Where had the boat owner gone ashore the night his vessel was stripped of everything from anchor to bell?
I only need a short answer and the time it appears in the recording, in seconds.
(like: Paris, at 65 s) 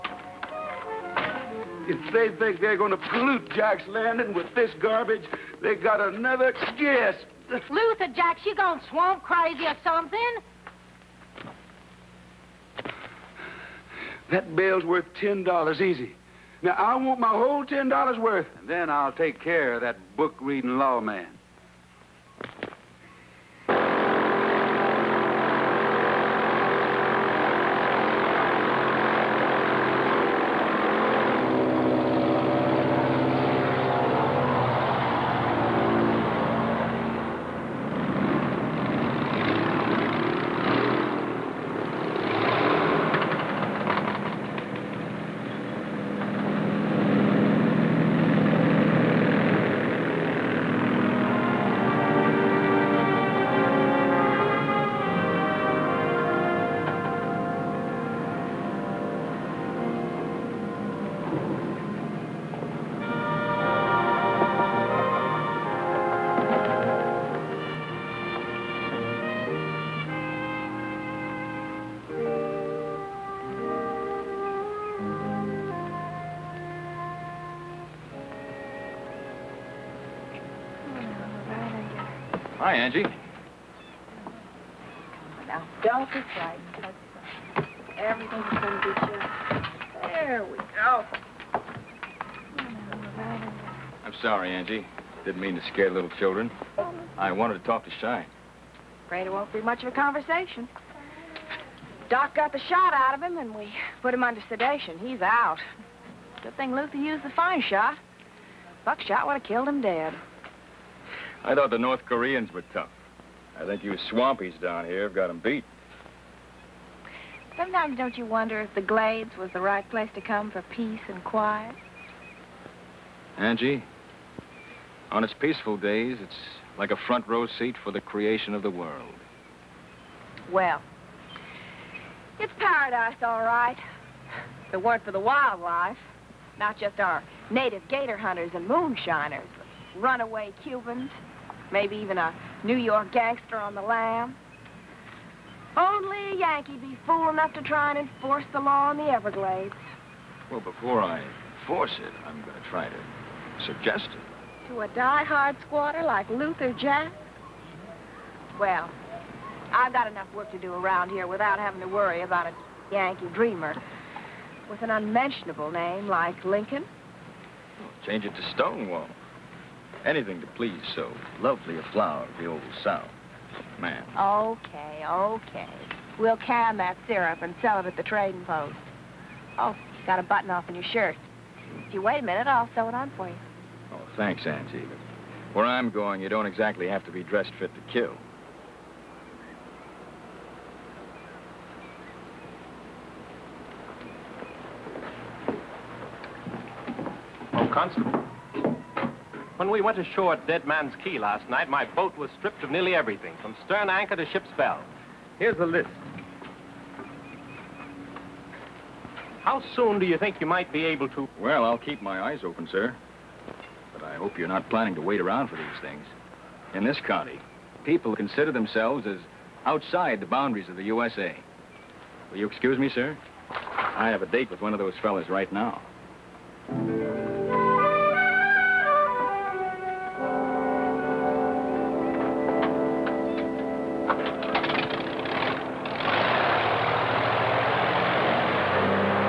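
Dead Man's Key, at 200 s.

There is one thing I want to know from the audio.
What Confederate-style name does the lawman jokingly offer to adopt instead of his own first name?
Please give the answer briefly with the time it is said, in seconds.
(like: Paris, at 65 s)
Stonewall, at 168 s.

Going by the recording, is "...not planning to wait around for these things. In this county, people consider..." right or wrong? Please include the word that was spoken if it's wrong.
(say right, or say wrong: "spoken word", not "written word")
right.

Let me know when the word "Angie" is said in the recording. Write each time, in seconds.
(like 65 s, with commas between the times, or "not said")
82 s, 94 s, 123 s.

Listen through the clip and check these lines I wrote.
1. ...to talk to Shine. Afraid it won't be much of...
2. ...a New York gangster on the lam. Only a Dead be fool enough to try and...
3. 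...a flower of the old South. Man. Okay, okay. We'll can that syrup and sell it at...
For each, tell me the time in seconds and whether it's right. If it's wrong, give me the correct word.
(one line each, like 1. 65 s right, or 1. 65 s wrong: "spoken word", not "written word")
1. 97 s right
2. 142 s wrong: "Yankee", not "Dead"
3. 171 s right.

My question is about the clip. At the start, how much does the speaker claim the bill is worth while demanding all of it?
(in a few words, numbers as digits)
$10.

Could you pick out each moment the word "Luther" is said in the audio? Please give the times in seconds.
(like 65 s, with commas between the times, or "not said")
7 s, 106 s, 156 s.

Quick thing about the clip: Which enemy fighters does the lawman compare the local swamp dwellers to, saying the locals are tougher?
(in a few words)
North Koreans.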